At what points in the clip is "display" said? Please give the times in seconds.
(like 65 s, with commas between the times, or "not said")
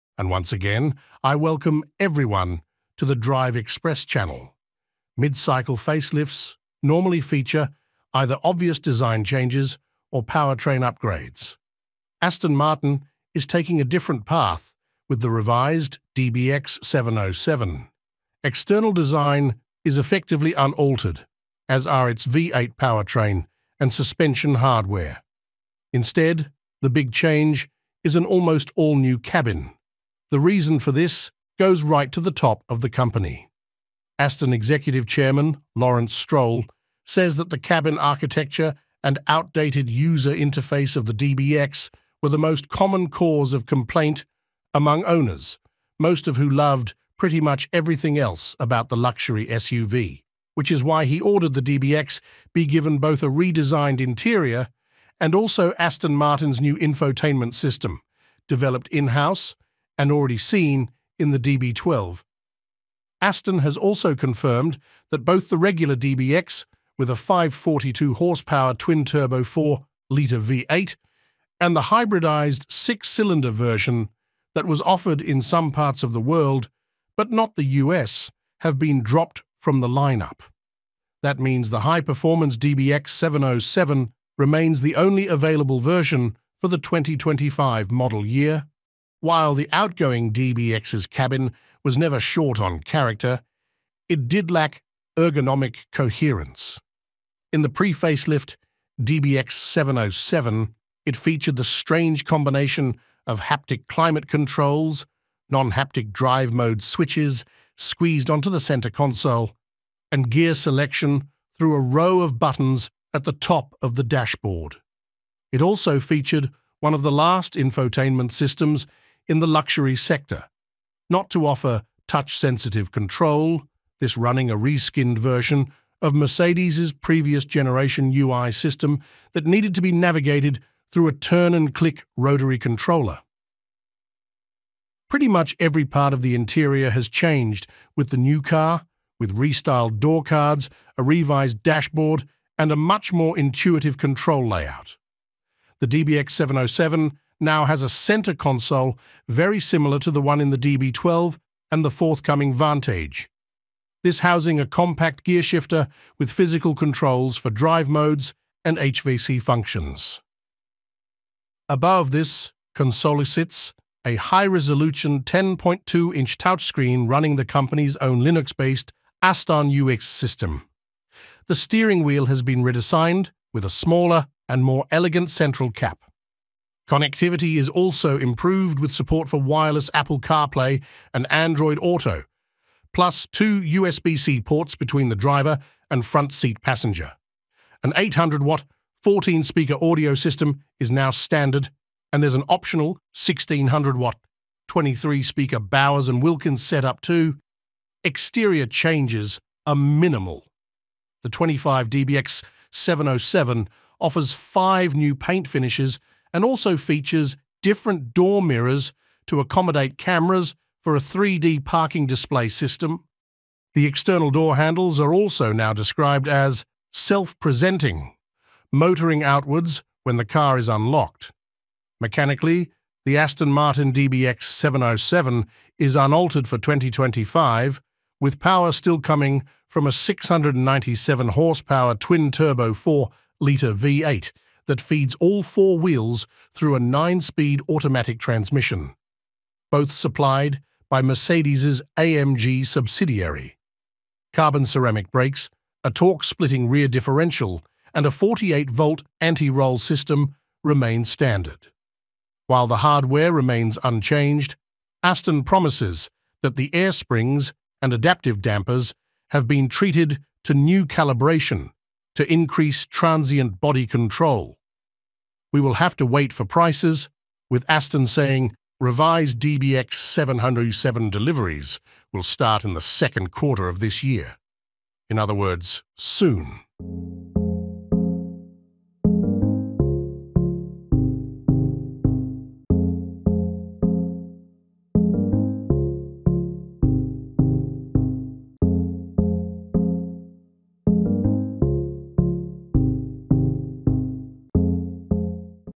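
212 s.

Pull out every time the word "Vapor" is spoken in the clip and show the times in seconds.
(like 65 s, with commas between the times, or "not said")
not said.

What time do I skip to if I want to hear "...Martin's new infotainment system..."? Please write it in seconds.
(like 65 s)
56 s.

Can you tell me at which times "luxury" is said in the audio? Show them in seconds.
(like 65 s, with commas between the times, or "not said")
48 s, 119 s.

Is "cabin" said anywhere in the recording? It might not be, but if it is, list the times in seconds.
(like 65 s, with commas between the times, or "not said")
29 s, 37 s, 91 s.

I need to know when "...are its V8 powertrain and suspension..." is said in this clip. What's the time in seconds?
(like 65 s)
21 s.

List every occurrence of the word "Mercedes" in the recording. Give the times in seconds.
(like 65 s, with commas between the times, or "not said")
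126 s, 241 s.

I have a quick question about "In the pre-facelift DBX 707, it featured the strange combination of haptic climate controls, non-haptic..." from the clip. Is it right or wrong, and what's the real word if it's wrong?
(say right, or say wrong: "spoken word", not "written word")
right.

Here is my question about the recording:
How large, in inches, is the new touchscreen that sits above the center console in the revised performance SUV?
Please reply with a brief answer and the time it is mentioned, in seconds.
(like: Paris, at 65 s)
10.2-inch, at 165 s.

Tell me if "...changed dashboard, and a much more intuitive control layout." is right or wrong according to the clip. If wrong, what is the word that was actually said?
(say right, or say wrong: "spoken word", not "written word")
wrong: "revised", not "changed".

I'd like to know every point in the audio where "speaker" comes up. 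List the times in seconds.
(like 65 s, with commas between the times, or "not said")
189 s, 194 s.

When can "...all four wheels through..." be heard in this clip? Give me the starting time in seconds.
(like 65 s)
235 s.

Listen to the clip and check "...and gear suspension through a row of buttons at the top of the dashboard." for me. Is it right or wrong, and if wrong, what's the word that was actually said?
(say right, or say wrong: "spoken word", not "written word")
wrong: "selection", not "suspension".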